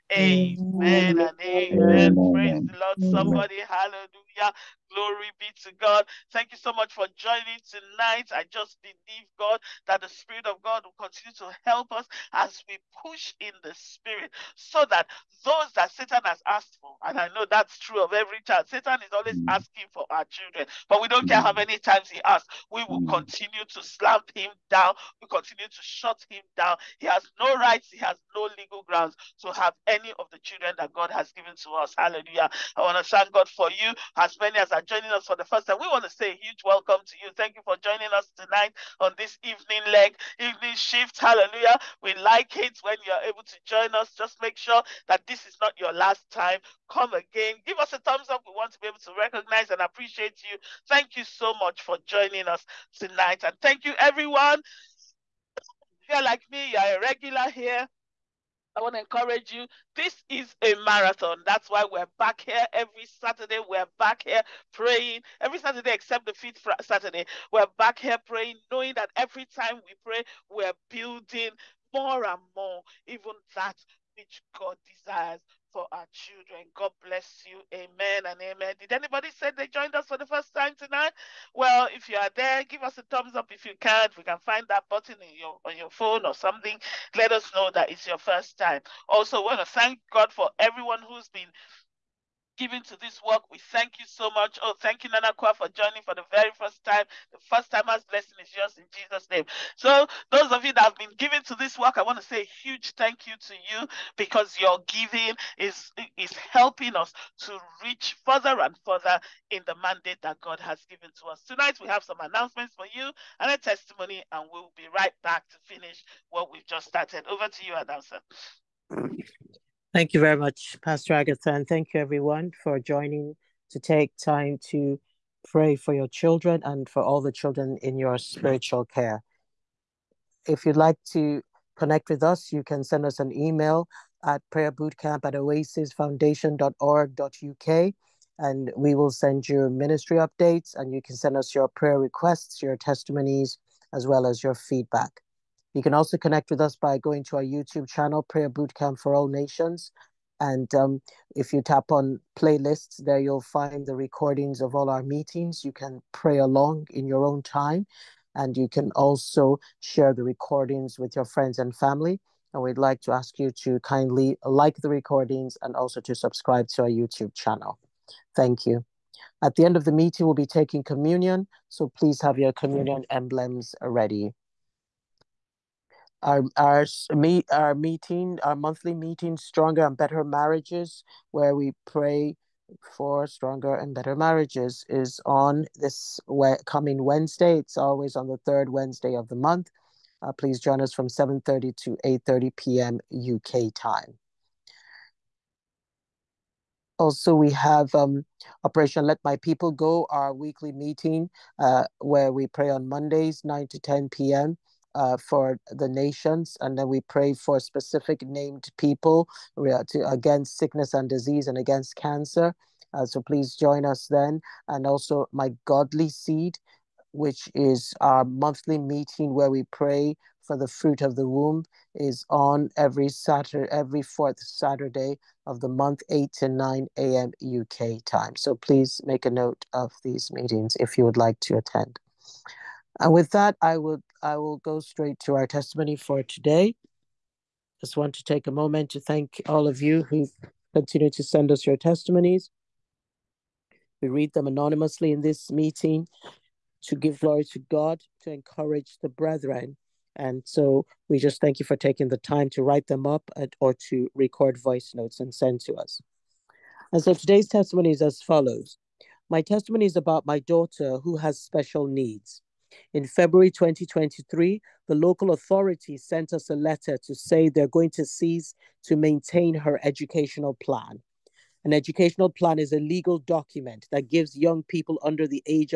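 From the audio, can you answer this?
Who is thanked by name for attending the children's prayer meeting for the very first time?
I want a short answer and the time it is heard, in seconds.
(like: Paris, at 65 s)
Nana Kwa, at 95 s.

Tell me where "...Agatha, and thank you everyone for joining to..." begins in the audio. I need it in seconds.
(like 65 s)
121 s.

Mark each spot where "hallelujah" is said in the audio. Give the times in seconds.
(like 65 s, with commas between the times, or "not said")
3 s, 31 s, 41 s.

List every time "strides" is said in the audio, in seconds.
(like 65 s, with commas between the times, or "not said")
not said.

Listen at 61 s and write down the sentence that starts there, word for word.
That's why we're back here every Saturday.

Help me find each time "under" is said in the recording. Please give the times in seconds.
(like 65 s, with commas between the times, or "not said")
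275 s.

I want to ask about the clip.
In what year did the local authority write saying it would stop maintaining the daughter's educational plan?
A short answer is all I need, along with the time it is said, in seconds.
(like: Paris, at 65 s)
2023, at 263 s.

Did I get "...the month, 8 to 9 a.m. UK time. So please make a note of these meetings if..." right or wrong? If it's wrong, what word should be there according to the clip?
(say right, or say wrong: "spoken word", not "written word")
right.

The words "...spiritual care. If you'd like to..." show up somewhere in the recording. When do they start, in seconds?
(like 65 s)
128 s.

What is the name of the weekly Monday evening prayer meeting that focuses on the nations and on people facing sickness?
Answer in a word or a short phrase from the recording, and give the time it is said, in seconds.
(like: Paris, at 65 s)
Operation Let My People Go, at 198 s.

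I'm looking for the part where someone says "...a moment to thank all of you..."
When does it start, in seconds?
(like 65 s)
238 s.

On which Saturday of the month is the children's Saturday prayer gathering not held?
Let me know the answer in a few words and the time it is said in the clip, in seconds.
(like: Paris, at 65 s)
fifth Saturday, at 66 s.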